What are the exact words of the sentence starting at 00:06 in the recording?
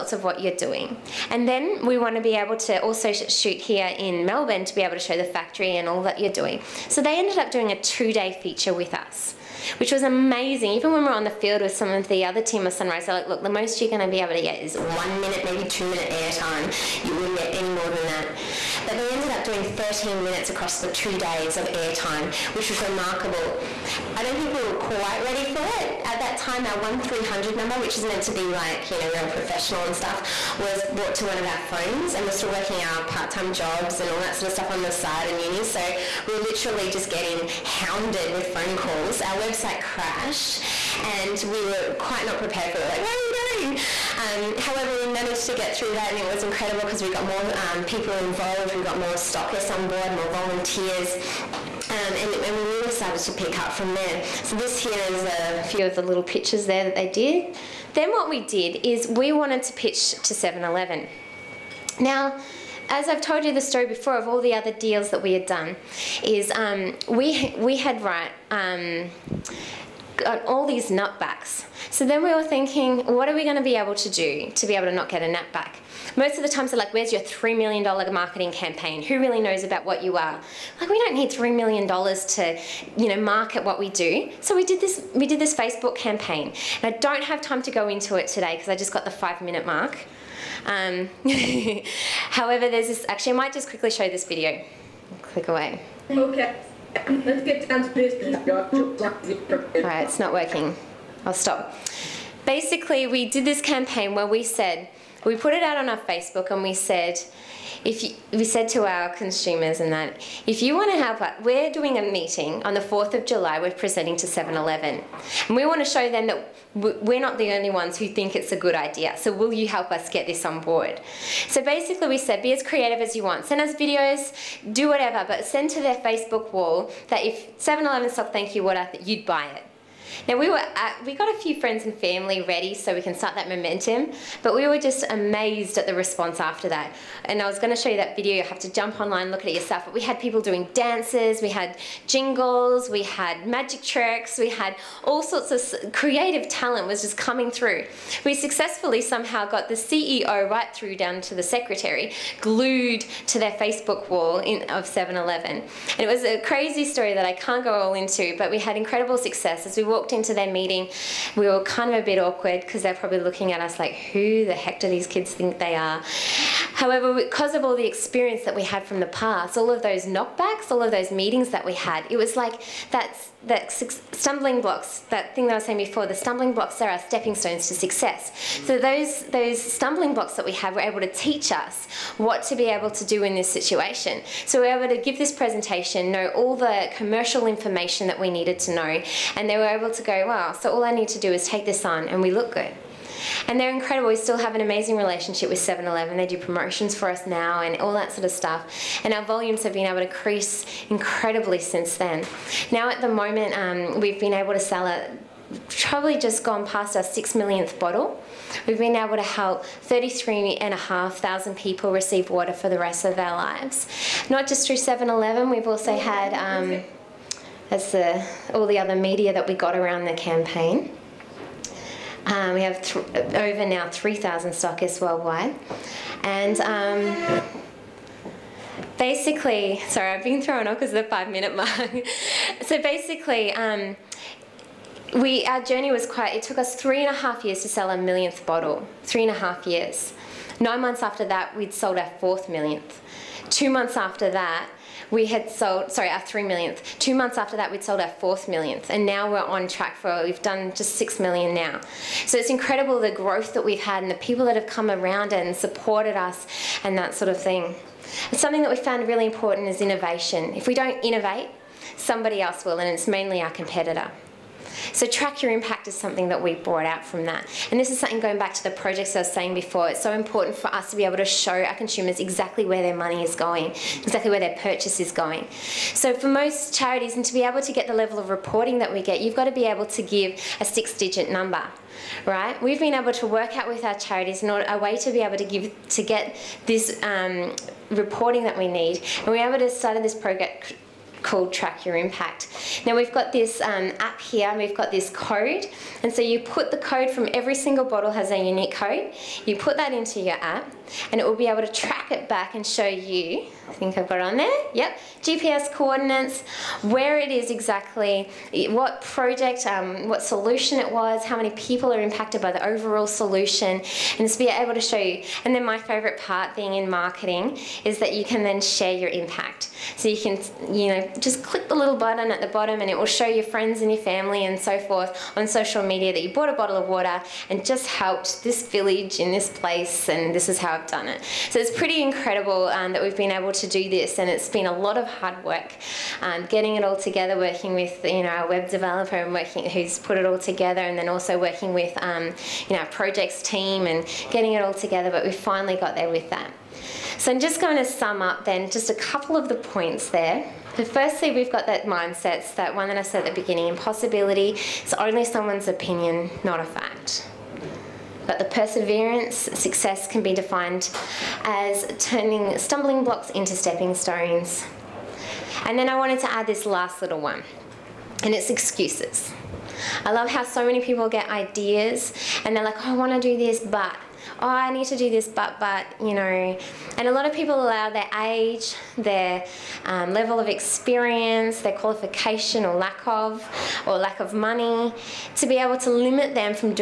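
So they ended up doing a two-day feature with us which was amazing.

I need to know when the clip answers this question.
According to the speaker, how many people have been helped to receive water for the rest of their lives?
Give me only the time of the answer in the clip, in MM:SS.
03:29.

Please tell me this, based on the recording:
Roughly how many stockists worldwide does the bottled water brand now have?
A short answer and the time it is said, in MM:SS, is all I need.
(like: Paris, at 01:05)
3,000, at 03:43.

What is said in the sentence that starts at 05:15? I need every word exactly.
And then my favourite part being in marketing is that you can then share your impact.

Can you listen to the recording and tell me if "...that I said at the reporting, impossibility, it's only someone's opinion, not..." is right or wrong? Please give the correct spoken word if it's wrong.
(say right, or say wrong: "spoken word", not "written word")
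wrong: "beginning", not "reporting".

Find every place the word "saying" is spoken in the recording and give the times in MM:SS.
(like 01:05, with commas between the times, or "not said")
02:55, 04:29.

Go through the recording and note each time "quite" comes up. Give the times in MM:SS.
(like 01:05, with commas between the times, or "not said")
00:24, 00:41, 03:56.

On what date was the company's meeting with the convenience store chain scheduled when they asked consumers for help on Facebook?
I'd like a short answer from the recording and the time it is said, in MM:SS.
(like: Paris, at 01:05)
4th of July, at 01:52.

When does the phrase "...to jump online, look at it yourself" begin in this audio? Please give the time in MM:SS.
02:18.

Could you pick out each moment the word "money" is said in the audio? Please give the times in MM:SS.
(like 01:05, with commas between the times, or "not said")
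04:32, 06:24.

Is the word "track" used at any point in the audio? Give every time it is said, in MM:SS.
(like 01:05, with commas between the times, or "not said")
04:09, 04:25, 04:51, 05:01.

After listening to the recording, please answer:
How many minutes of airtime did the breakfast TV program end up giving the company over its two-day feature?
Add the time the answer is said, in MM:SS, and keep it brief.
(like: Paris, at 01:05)
13 minutes, at 00:19.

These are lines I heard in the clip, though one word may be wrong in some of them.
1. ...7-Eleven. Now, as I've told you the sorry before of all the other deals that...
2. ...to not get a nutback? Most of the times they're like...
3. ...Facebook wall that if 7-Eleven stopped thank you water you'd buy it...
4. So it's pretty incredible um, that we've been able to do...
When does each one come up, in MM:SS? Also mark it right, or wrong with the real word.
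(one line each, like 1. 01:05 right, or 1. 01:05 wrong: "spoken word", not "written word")
1. 01:00 wrong: "story", not "sorry"
2. 01:14 right
3. 02:05 right
4. 05:31 right.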